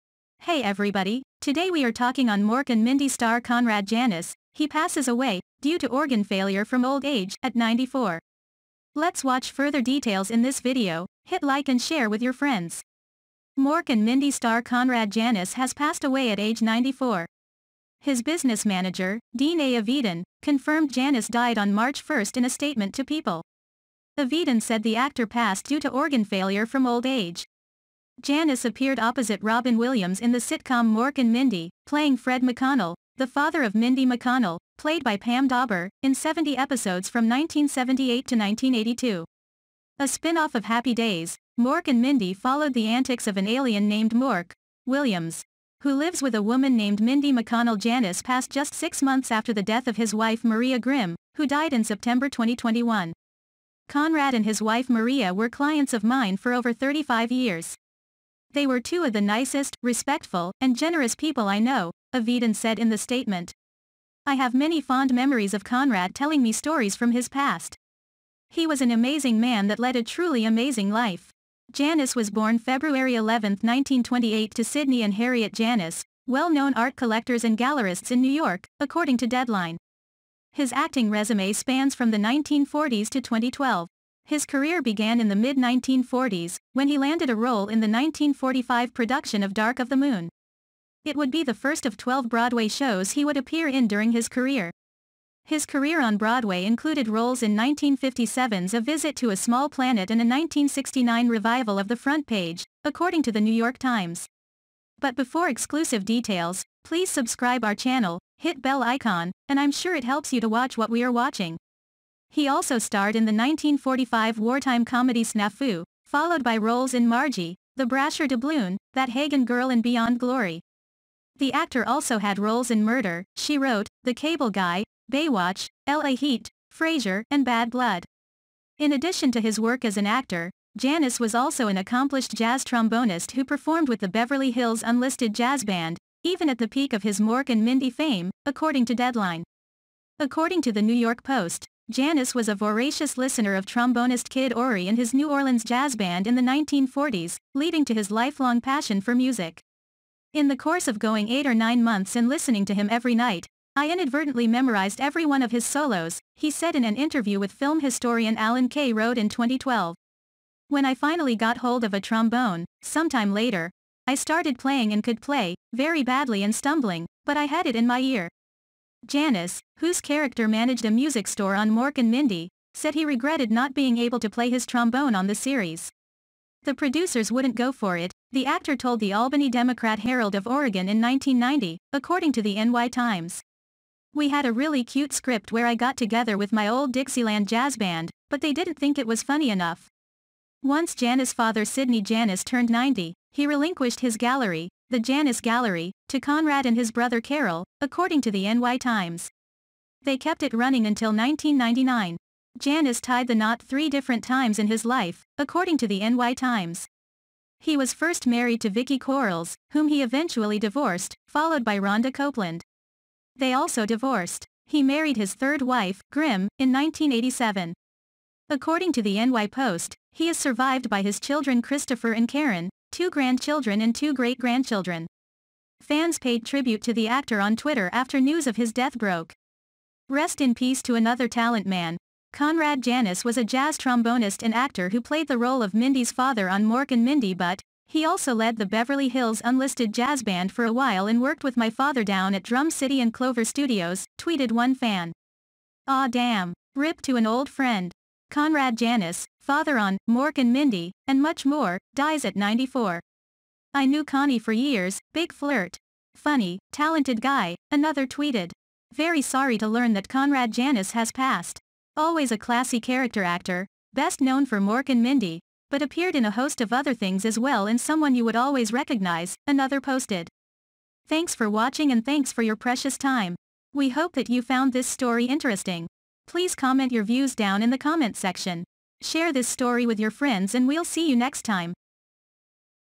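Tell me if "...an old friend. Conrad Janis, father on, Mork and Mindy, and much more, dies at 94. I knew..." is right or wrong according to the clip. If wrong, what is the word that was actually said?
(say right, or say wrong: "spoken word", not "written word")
right.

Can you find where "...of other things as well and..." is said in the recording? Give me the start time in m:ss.
4:26.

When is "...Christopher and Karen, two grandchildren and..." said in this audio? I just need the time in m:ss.
3:41.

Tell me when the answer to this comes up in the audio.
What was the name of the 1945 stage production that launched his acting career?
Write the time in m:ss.
1:29.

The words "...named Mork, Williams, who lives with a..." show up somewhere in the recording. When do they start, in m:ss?
0:43.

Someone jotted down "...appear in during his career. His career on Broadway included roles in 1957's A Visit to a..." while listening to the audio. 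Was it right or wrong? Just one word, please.
right.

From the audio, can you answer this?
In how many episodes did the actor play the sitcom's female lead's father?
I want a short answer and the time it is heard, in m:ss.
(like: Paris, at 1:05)
70, at 0:36.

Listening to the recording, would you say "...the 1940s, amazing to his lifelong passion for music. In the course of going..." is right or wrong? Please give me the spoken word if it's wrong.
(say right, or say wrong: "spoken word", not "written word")
wrong: "leading", not "amazing".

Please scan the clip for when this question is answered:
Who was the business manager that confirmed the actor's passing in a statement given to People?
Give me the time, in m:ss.
0:19.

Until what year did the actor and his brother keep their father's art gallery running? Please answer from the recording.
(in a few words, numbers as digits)
1999.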